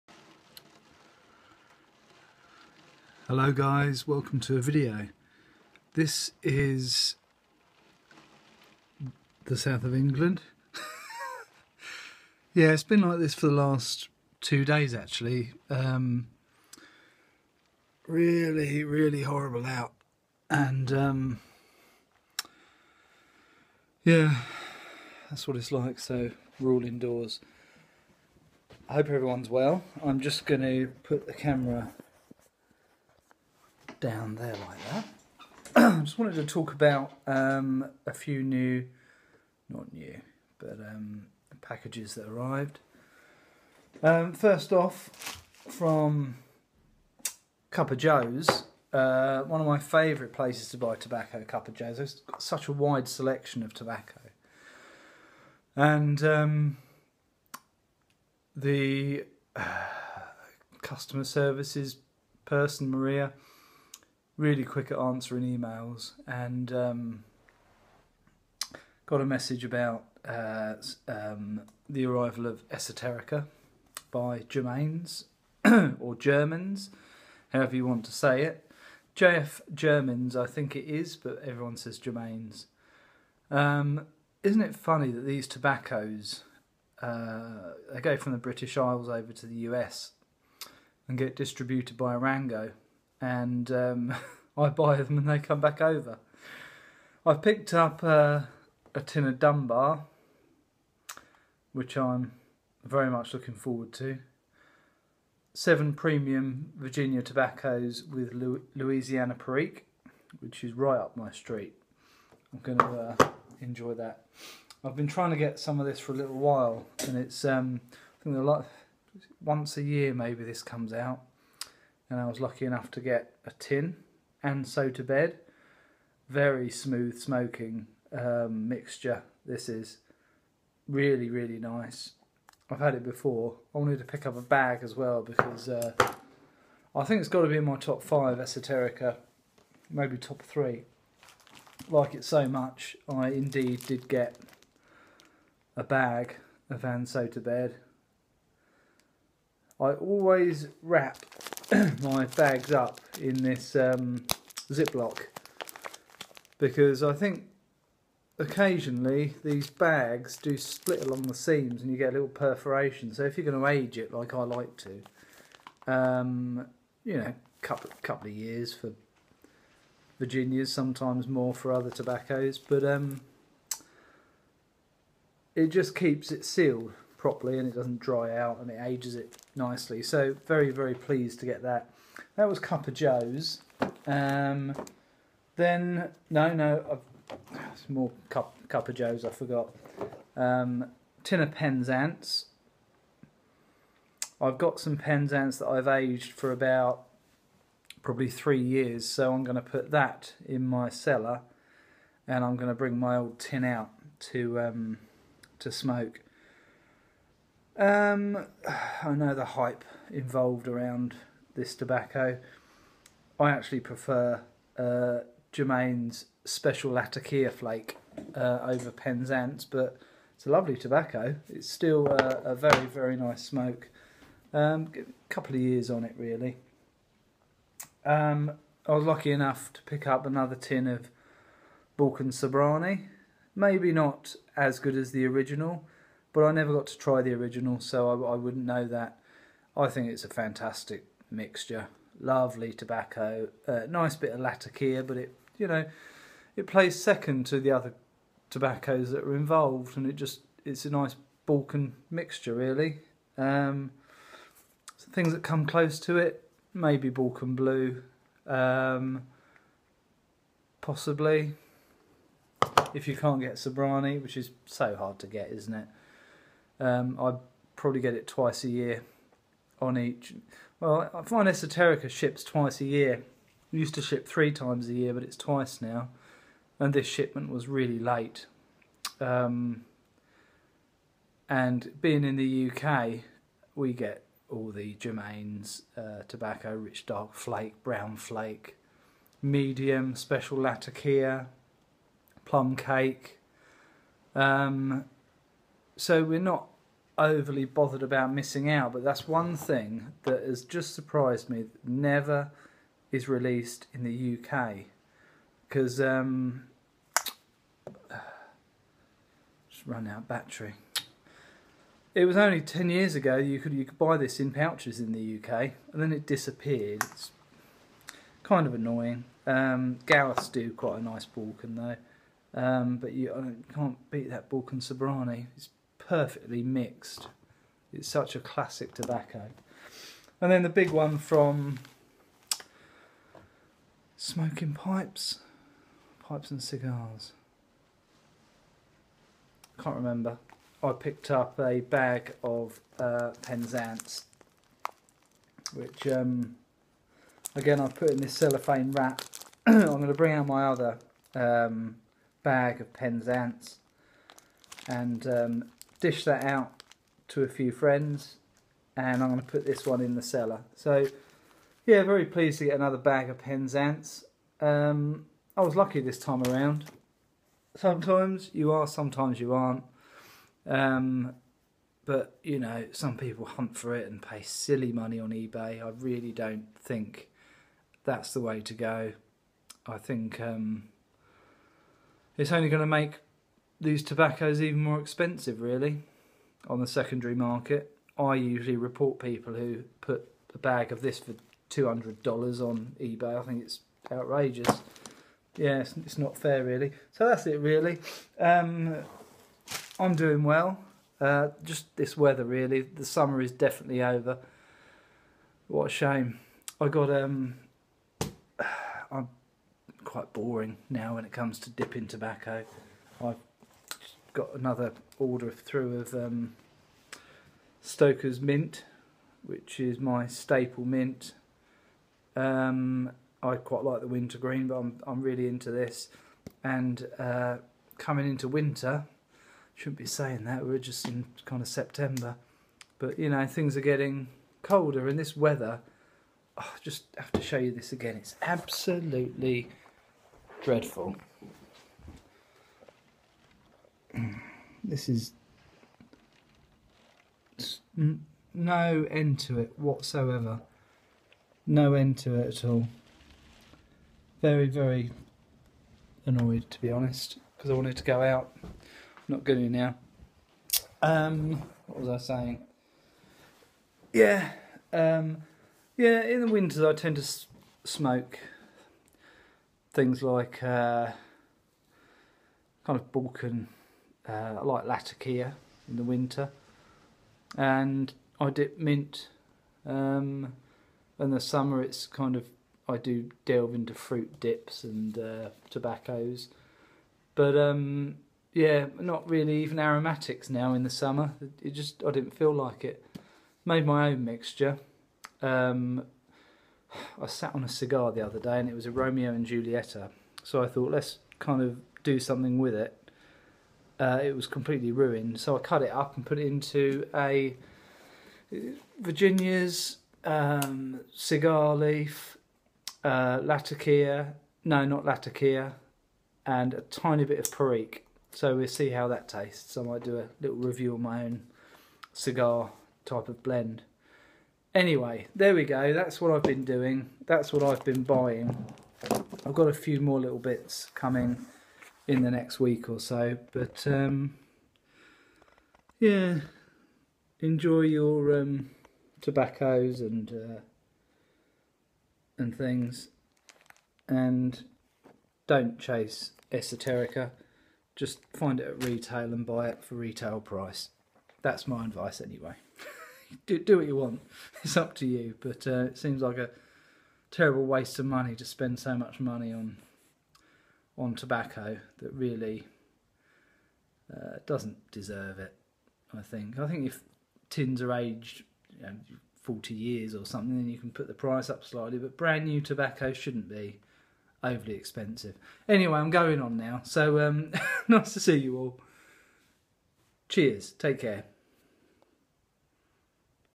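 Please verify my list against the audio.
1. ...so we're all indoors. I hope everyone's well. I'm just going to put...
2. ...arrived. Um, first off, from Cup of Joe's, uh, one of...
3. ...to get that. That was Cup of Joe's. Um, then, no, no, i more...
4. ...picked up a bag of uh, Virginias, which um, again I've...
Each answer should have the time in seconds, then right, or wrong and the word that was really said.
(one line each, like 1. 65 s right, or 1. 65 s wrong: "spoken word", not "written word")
1. 25 s right
2. 42 s right
3. 181 s right
4. 340 s wrong: "Penzance", not "Virginias".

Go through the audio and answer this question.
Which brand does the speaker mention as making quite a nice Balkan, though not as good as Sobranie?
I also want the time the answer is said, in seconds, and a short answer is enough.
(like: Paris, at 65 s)
Gallus, at 320 s.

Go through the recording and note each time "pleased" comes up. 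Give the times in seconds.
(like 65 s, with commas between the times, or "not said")
180 s, 362 s.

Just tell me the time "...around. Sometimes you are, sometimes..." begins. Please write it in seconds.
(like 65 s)
366 s.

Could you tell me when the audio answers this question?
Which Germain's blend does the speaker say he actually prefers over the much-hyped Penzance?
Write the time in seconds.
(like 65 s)
216 s.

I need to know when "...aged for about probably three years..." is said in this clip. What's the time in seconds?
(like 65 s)
195 s.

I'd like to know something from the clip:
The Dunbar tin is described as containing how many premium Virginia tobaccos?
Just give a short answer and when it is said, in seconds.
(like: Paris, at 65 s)
7, at 105 s.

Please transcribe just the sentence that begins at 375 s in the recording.
I really don't think that's the way to go.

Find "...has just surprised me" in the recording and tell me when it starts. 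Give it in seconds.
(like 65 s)
300 s.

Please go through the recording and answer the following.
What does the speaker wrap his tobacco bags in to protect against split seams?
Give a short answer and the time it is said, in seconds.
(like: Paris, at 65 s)
Ziploc, at 154 s.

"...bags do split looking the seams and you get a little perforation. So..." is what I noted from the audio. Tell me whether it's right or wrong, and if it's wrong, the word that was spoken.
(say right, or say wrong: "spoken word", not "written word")
wrong: "along", not "looking".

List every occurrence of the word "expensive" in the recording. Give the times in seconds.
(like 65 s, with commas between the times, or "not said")
384 s, 574 s.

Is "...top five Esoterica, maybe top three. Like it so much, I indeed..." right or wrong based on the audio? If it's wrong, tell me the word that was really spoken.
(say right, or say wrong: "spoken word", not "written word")
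right.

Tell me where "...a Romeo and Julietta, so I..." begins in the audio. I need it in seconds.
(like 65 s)
498 s.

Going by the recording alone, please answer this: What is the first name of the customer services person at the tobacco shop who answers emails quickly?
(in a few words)
Maria.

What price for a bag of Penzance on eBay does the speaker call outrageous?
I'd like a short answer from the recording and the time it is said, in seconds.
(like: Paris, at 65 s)
$200, at 391 s.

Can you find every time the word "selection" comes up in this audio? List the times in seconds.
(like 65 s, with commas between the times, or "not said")
53 s.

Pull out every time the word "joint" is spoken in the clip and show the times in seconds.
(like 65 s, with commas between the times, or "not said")
not said.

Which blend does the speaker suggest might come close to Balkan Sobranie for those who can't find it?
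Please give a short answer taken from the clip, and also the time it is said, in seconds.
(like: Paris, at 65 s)
Balkan Blue, at 257 s.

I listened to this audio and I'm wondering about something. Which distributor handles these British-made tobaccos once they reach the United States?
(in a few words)
Arango.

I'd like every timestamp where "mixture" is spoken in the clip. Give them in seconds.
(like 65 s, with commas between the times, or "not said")
128 s, 241 s, 252 s, 494 s.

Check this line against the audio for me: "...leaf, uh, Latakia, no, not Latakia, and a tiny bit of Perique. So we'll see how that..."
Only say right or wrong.
right.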